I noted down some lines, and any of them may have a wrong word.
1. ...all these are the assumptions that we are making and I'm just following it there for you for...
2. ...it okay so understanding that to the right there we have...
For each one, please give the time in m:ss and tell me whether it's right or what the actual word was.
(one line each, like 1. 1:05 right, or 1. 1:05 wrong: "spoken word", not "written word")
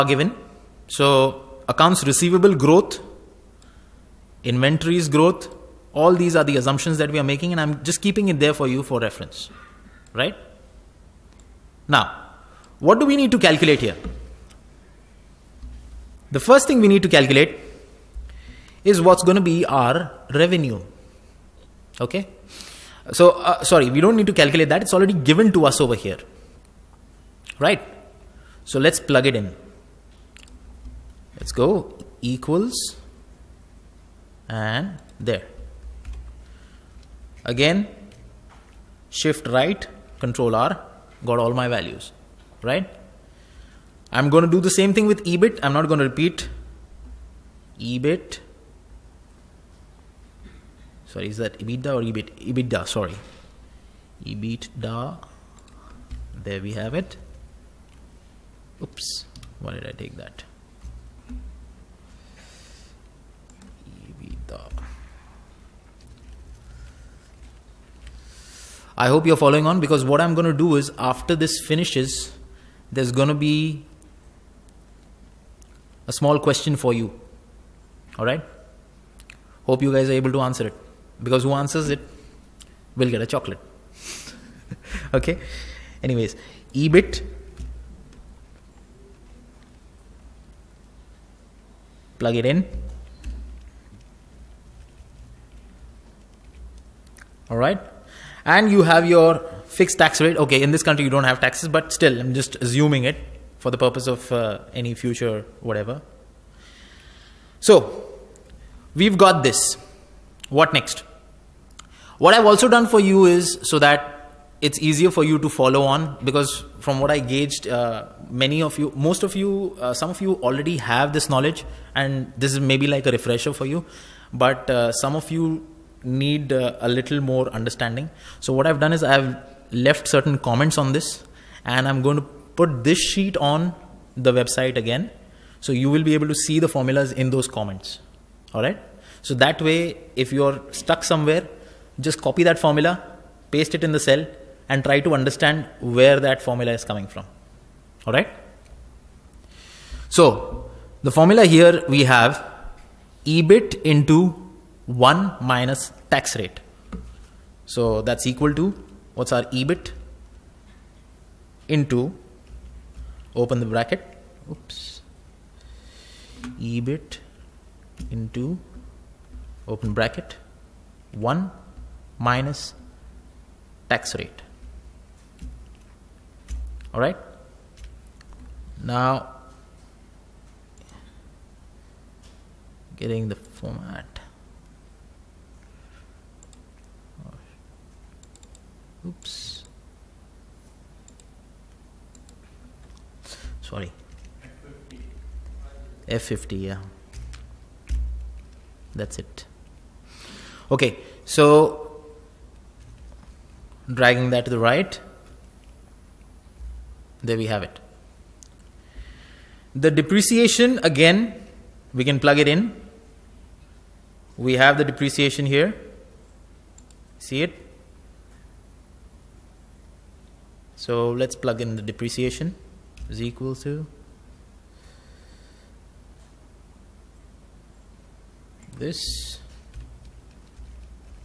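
1. 0:05 wrong: "keeping", not "following"
2. 3:19 wrong: "dragging", not "understanding".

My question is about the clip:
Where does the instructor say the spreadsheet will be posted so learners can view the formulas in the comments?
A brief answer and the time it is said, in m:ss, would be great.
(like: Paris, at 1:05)
On the website, at 2:13.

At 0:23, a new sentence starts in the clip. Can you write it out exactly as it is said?
So, uh, sorry, we don't need to calculate that.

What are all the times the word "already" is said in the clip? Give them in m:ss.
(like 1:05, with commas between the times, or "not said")
0:24, 2:00.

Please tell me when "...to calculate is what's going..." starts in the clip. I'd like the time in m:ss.
0:17.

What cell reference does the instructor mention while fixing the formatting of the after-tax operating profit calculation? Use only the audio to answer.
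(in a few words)
F50.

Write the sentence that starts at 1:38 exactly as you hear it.
and you have your fixed tax rate.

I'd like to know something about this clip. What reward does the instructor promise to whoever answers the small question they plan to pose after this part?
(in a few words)
A chocolate.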